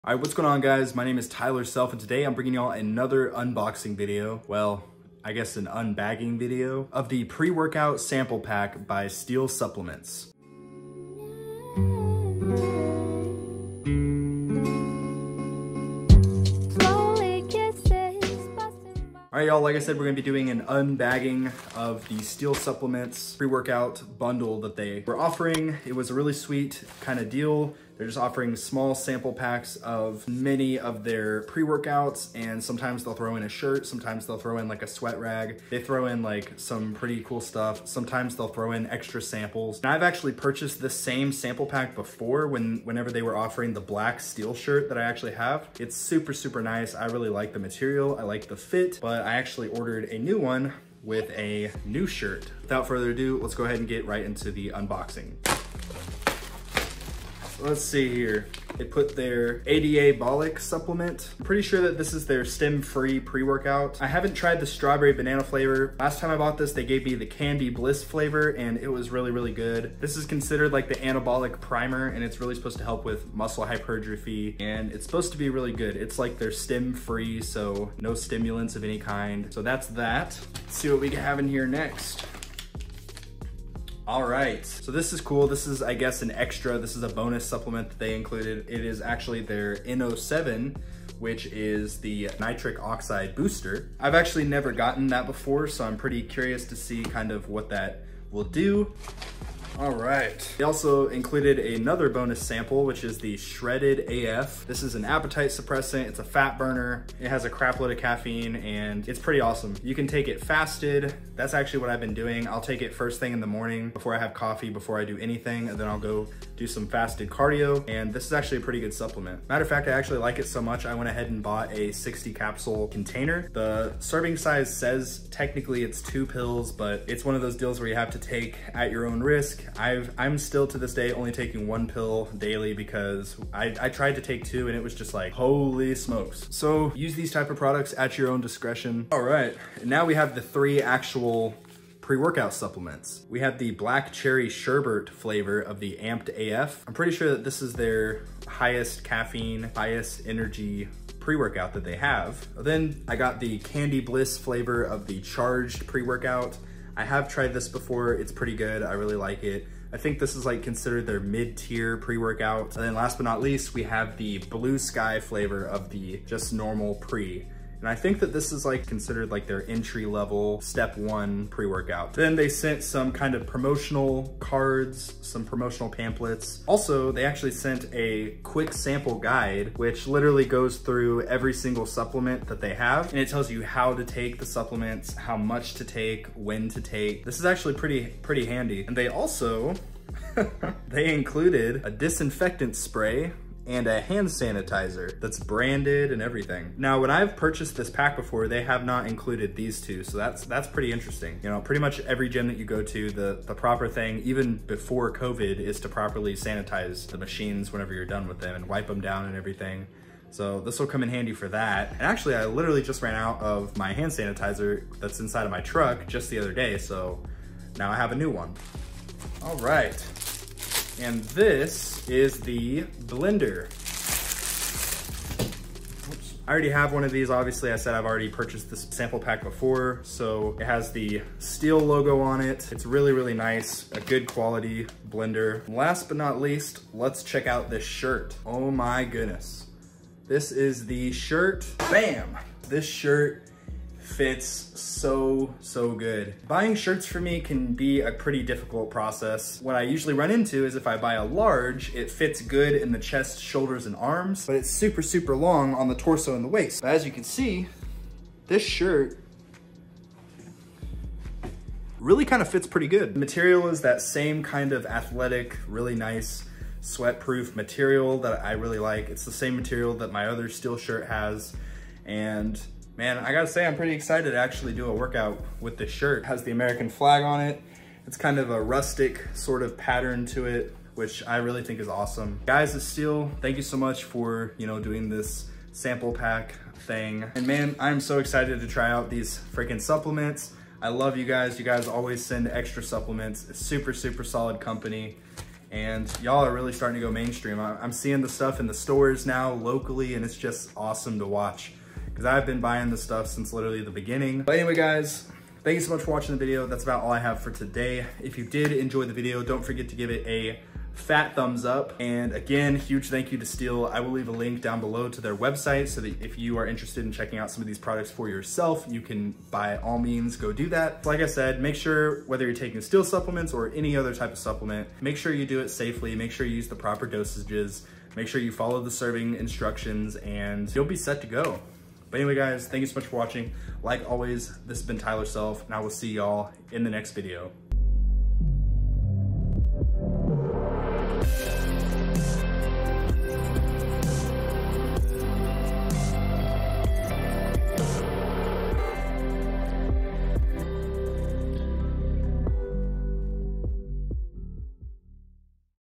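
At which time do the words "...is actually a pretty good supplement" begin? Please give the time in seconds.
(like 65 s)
118 s.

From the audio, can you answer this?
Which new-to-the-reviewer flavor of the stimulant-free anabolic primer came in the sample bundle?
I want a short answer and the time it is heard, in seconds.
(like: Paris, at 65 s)
Strawberry banana, at 64 s.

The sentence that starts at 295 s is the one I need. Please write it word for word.
And y'all are really starting to go mainstream.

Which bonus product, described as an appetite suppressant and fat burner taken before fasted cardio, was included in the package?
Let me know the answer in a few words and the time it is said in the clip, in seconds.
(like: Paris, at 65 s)
Shredded AF, at 103 s.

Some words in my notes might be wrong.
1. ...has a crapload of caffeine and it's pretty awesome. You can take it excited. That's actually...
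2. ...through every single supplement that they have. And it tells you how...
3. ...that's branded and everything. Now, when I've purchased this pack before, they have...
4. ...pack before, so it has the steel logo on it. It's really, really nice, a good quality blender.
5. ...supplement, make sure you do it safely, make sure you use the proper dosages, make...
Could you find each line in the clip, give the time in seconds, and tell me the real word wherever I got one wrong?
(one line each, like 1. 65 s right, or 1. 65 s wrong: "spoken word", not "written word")
1. 107 s wrong: "fasted", not "excited"
2. 180 s right
3. 195 s right
4. 229 s right
5. 324 s right.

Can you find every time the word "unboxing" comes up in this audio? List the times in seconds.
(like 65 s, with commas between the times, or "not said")
3 s, 54 s.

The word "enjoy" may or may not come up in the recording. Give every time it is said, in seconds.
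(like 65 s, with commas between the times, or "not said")
308 s.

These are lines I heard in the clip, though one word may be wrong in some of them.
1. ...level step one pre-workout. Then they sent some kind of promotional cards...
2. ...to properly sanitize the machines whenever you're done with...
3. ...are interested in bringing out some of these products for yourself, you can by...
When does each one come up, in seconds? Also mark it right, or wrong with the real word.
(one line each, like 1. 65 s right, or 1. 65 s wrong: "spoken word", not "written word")
1. 170 s right
2. 205 s right
3. 316 s wrong: "checking", not "bringing".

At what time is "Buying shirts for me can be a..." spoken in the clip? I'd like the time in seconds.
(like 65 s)
246 s.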